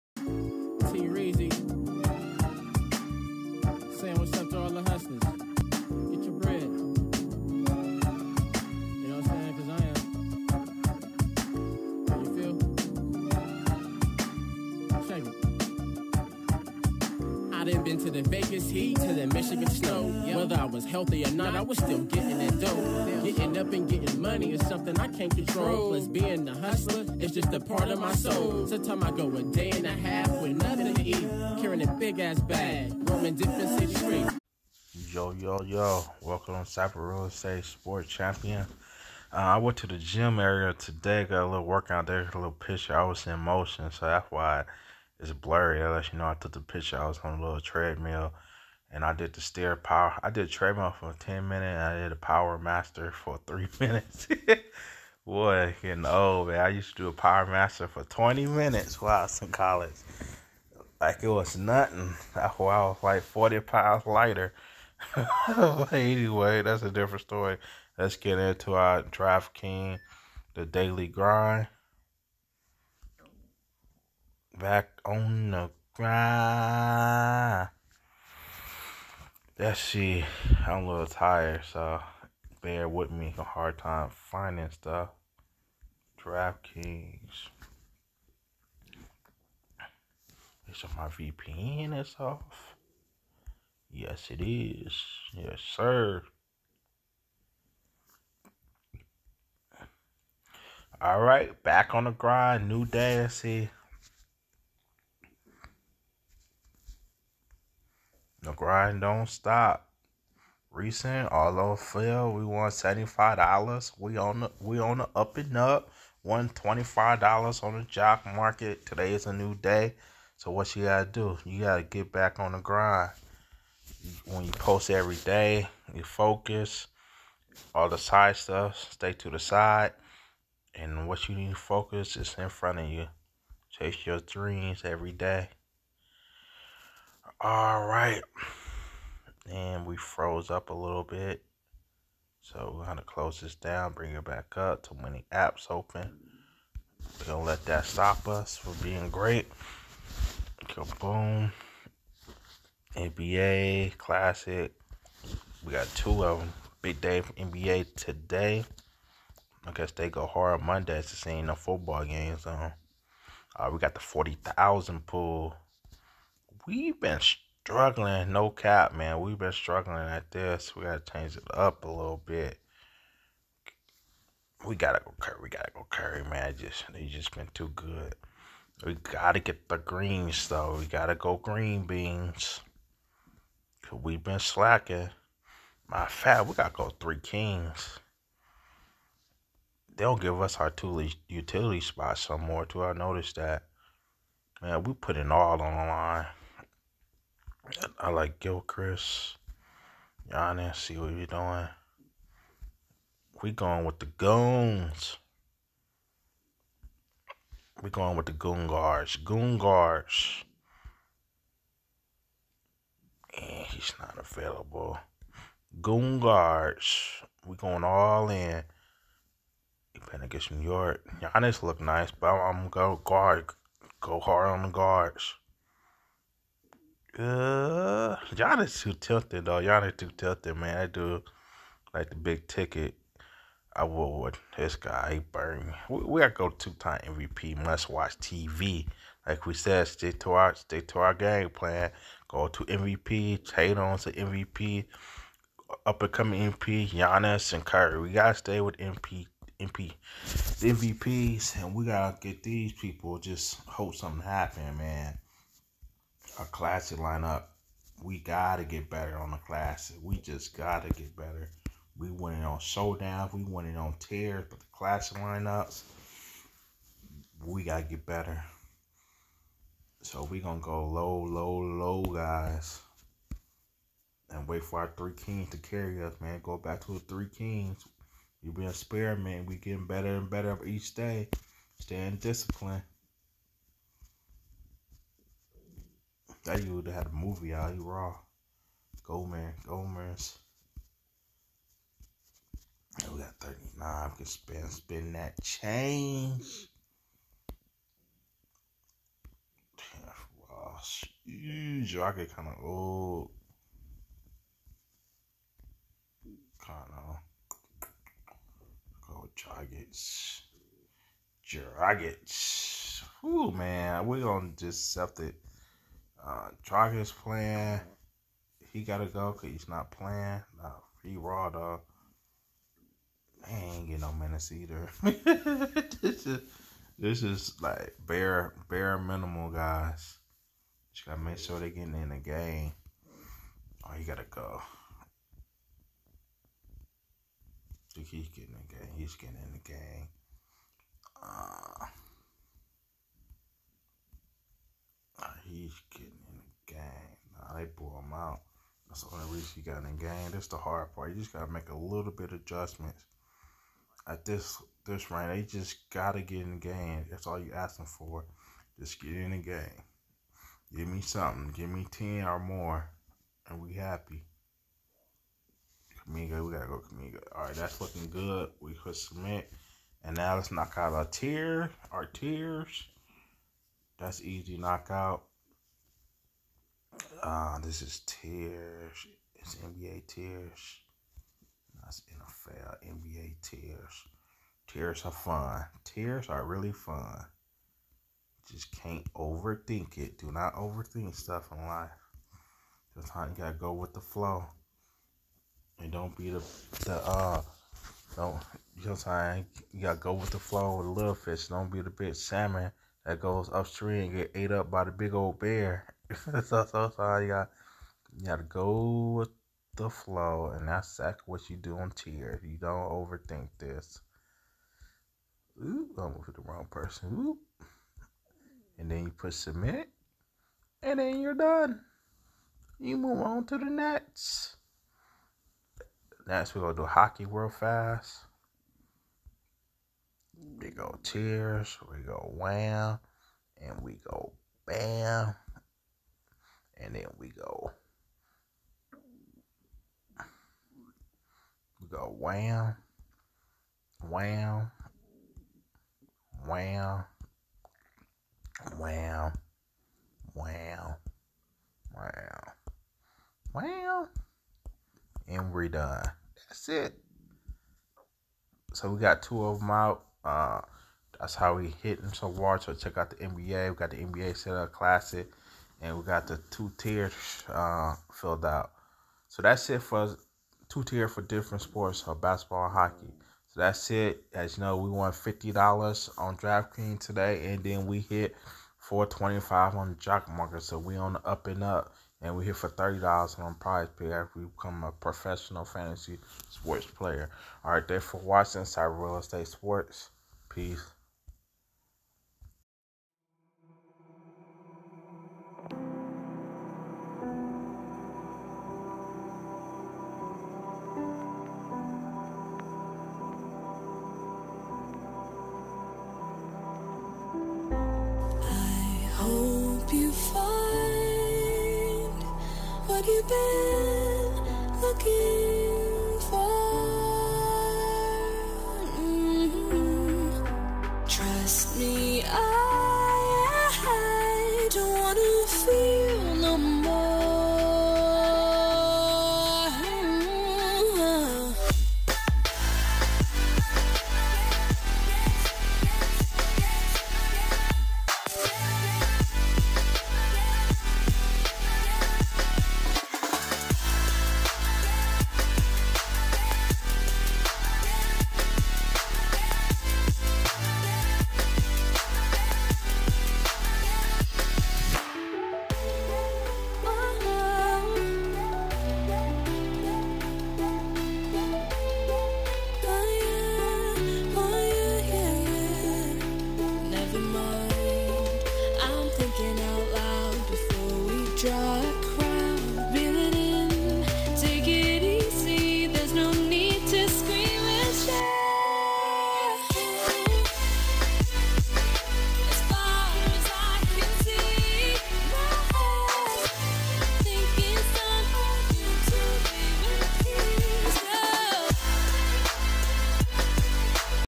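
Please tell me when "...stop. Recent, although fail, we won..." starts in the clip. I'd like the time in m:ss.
1:49.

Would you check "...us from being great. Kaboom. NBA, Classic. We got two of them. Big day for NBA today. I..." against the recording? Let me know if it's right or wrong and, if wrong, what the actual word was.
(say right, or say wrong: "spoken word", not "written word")
right.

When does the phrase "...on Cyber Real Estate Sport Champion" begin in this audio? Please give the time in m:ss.
0:36.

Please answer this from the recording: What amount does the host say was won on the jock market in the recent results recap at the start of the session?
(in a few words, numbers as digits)
$25.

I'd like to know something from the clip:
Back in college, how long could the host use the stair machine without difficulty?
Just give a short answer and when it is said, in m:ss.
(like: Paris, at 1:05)
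20 minutes, at 0:58.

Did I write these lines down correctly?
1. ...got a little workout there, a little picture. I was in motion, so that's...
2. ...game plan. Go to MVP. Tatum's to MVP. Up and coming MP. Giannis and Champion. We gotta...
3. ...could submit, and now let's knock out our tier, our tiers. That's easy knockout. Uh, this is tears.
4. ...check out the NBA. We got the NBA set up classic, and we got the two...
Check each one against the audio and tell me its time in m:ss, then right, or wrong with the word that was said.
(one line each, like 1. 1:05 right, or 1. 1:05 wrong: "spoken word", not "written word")
1. 0:41 right
2. 4:01 wrong: "Curry", not "Champion"
3. 6:08 right
4. 7:42 right.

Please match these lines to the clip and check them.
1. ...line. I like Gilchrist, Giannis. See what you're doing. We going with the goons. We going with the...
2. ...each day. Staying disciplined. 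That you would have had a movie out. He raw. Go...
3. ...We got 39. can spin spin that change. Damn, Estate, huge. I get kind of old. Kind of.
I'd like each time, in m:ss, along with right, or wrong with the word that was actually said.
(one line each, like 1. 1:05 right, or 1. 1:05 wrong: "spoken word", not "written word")
1. 3:15 right
2. 4:40 right
3. 4:53 wrong: "Wow", not "Estate".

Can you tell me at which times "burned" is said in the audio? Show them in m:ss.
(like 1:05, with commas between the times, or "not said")
3:55.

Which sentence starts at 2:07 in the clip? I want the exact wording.
All the side stuff, stay to the side.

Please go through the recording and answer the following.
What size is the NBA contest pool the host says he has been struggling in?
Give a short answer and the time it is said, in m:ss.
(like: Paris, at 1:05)
40,000, at 2:43.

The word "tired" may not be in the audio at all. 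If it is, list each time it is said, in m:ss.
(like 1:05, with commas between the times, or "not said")
1:21.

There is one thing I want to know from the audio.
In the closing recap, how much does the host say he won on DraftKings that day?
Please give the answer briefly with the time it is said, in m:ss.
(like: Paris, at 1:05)
$50, at 7:55.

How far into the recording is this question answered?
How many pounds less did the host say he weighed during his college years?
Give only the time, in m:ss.
1:03.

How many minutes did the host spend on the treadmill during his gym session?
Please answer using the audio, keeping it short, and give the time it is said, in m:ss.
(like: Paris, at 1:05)
10, at 0:51.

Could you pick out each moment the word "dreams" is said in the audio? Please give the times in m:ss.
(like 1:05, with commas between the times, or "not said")
2:14.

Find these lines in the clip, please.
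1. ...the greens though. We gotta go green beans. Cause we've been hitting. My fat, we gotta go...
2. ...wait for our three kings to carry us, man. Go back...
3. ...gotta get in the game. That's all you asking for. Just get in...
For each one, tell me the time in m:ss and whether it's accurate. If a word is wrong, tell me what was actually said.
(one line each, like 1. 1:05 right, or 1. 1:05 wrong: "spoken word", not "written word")
1. 2:59 wrong: "slacking", not "hitting"
2. 4:34 right
3. 5:55 right.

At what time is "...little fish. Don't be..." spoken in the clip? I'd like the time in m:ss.
6:40.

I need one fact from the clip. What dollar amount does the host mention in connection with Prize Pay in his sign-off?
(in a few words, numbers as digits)
$30.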